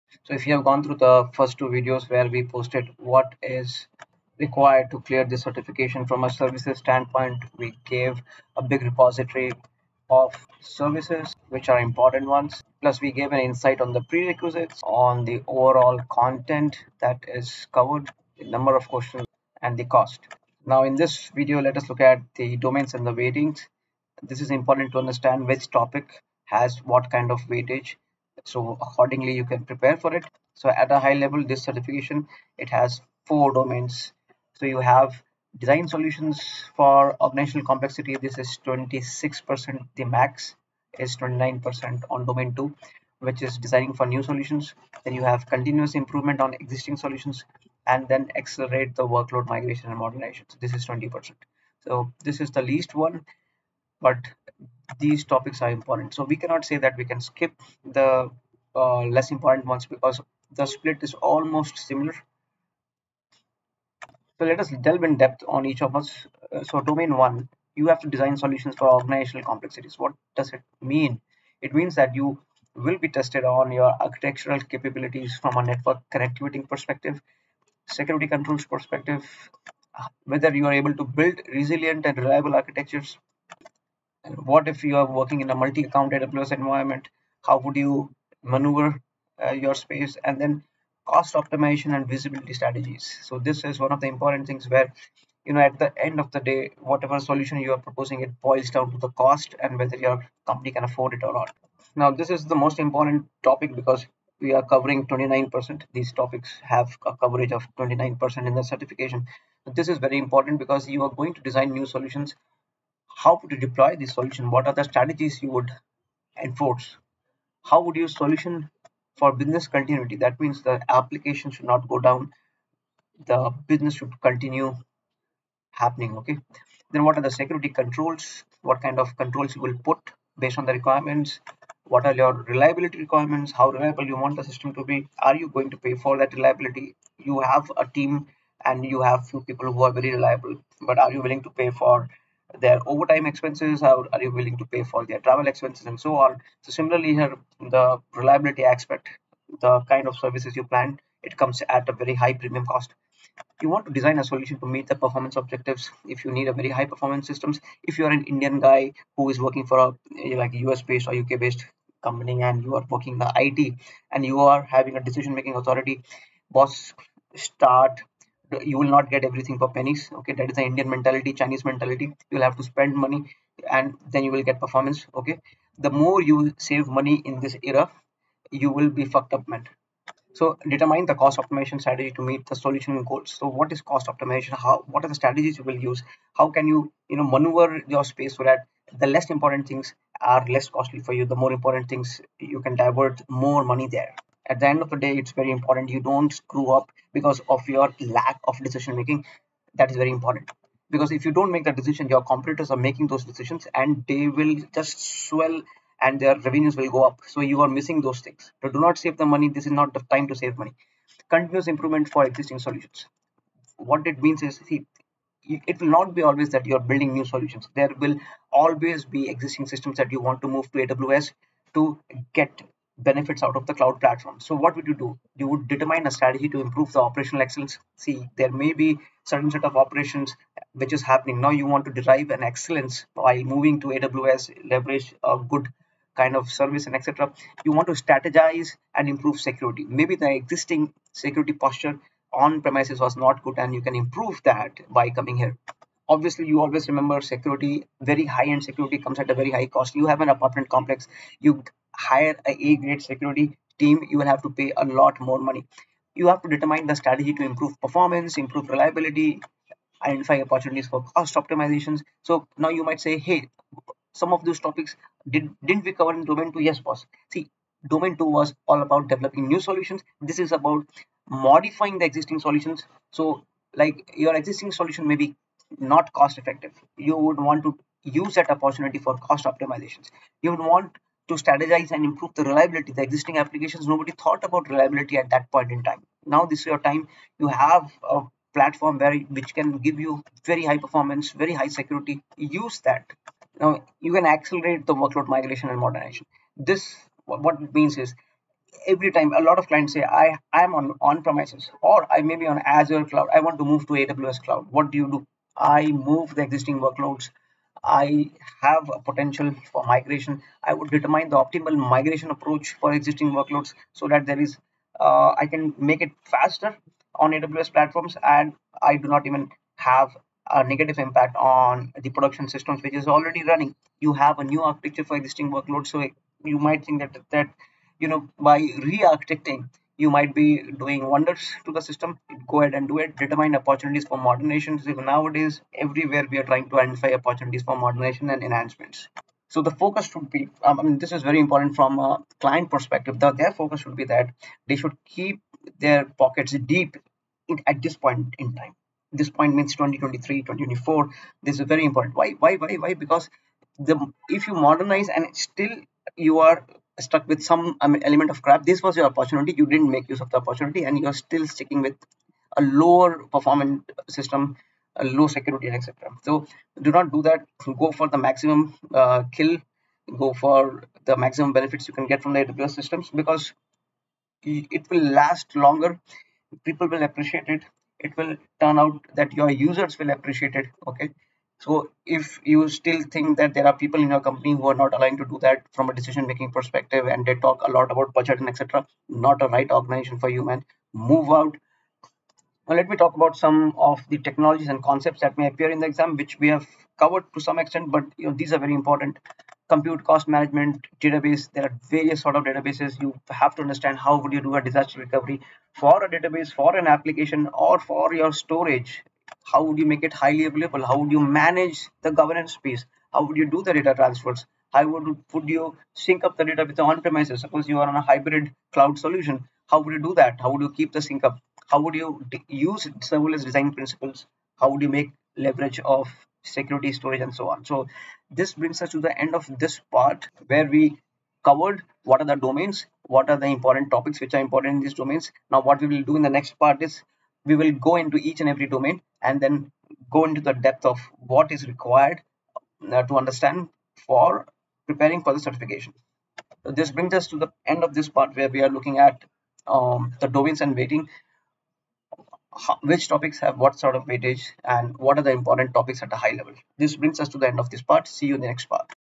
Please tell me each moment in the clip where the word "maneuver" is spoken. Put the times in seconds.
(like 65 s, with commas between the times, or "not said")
88 s, 187 s.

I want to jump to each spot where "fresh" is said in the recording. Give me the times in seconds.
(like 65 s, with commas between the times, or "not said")
not said.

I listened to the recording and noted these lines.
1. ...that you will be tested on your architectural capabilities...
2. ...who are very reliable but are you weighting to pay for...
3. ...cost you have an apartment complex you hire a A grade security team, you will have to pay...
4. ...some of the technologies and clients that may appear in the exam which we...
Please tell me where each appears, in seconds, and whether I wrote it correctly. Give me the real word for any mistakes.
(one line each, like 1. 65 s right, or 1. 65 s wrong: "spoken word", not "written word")
1. 71 s right
2. 139 s wrong: "willing", not "weighting"
3. 249 s right
4. 393 s wrong: "concepts", not "clients".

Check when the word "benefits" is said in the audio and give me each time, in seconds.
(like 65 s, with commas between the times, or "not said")
222 s, 371 s.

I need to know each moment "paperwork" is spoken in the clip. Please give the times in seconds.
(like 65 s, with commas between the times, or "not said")
not said.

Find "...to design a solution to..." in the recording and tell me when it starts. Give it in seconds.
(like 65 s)
153 s.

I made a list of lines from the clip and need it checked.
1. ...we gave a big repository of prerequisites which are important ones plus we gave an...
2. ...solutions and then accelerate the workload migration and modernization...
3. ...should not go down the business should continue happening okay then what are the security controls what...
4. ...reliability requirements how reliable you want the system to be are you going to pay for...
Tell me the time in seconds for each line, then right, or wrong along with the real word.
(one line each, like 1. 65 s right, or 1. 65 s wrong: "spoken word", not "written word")
1. 7 s wrong: "services", not "prerequisites"
2. 46 s right
3. 121 s right
4. 132 s right.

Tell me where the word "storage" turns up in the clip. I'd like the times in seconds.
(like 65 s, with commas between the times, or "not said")
408 s, 426 s.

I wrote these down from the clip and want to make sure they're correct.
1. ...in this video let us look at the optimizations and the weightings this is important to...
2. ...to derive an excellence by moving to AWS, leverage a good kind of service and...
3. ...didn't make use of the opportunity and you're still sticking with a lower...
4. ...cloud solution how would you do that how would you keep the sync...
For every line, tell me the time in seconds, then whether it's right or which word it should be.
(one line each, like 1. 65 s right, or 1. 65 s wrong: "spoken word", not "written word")
1. 20 s wrong: "domains", not "optimizations"
2. 231 s right
3. 359 s right
4. 418 s right.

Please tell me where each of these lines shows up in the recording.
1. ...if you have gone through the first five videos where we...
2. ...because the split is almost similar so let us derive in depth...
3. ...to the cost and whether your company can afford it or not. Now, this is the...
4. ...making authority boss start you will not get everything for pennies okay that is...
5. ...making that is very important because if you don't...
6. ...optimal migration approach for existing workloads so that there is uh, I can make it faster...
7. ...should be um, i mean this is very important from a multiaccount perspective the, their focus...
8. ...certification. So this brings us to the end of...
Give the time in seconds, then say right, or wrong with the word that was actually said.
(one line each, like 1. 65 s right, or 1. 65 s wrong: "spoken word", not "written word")
1. 0 s wrong: "two", not "five"
2. 59 s wrong: "delve", not "derive"
3. 98 s right
4. 165 s right
5. 198 s right
6. 311 s right
7. 340 s wrong: "client", not "multiaccount"
8. 445 s right.